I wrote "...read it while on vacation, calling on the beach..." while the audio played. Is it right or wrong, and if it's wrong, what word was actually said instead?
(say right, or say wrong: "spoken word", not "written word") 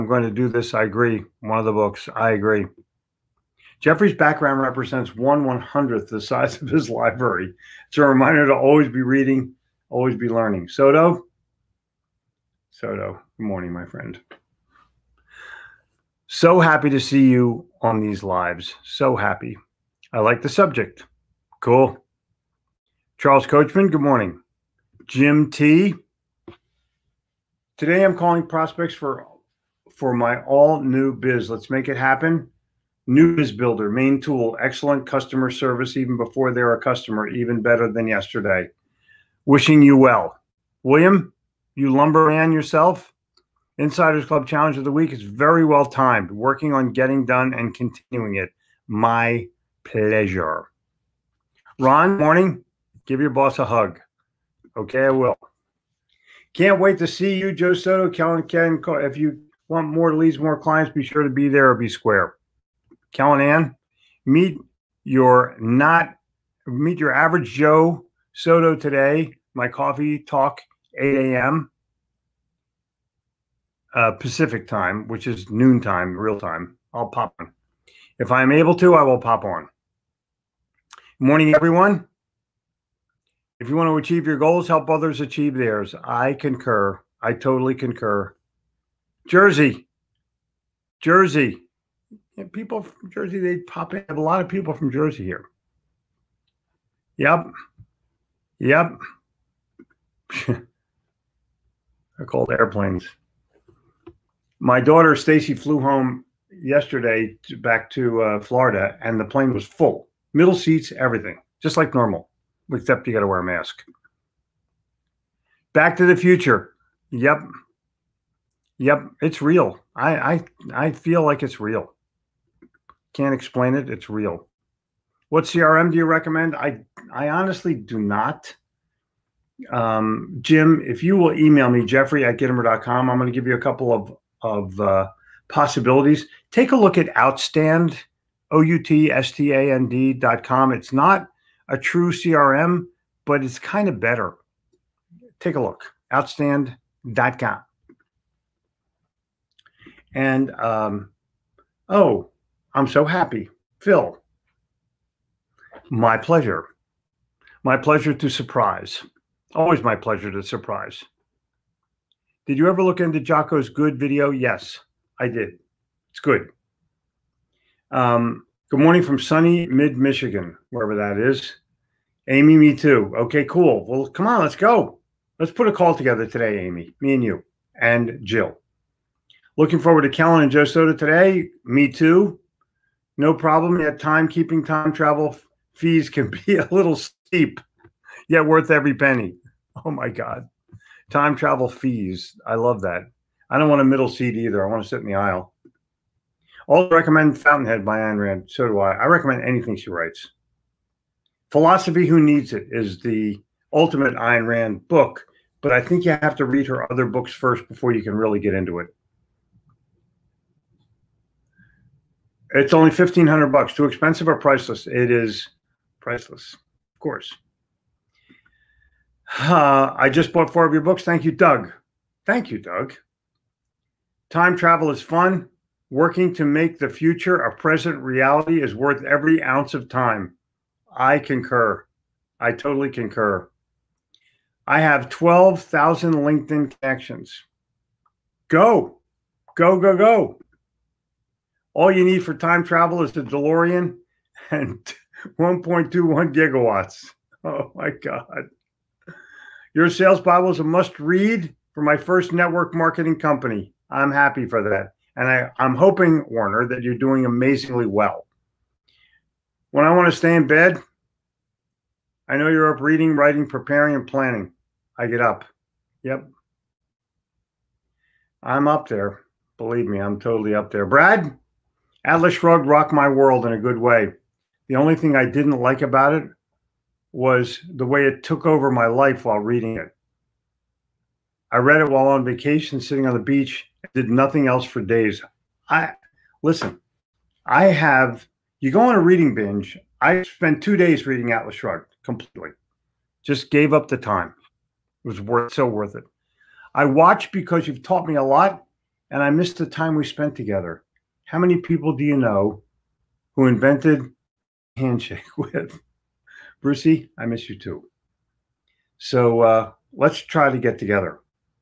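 wrong: "sitting", not "calling".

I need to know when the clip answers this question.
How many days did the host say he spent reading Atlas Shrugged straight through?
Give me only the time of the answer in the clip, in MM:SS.
04:50.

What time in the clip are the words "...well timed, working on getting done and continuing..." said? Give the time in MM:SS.
00:45.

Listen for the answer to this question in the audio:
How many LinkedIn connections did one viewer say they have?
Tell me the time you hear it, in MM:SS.
03:55.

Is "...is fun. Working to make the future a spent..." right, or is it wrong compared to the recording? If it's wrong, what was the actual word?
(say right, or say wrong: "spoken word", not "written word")
wrong: "present", not "spent".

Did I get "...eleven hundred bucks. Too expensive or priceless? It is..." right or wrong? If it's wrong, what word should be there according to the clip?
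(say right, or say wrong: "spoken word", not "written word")
wrong: "fifteen", not "eleven".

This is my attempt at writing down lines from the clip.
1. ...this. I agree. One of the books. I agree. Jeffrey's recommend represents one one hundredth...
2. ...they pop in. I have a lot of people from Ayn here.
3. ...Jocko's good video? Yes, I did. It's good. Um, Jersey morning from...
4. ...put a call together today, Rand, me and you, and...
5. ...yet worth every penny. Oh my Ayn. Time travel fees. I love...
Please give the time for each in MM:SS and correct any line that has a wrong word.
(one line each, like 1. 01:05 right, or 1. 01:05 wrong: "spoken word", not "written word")
1. 00:00 wrong: "background", not "recommend"
2. 01:33 wrong: "Jersey", not "Ayn"
3. 02:43 wrong: "Good", not "Jersey"
4. 02:55 wrong: "Amy", not "Rand"
5. 03:08 wrong: "God", not "Ayn".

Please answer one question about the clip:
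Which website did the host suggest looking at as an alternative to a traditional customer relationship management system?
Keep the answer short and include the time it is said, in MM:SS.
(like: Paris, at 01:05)
outstand.com, at 02:26.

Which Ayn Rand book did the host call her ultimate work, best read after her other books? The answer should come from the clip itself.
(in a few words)
Philosophy Who Needs It.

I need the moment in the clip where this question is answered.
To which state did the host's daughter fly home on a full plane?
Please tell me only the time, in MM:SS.
01:48.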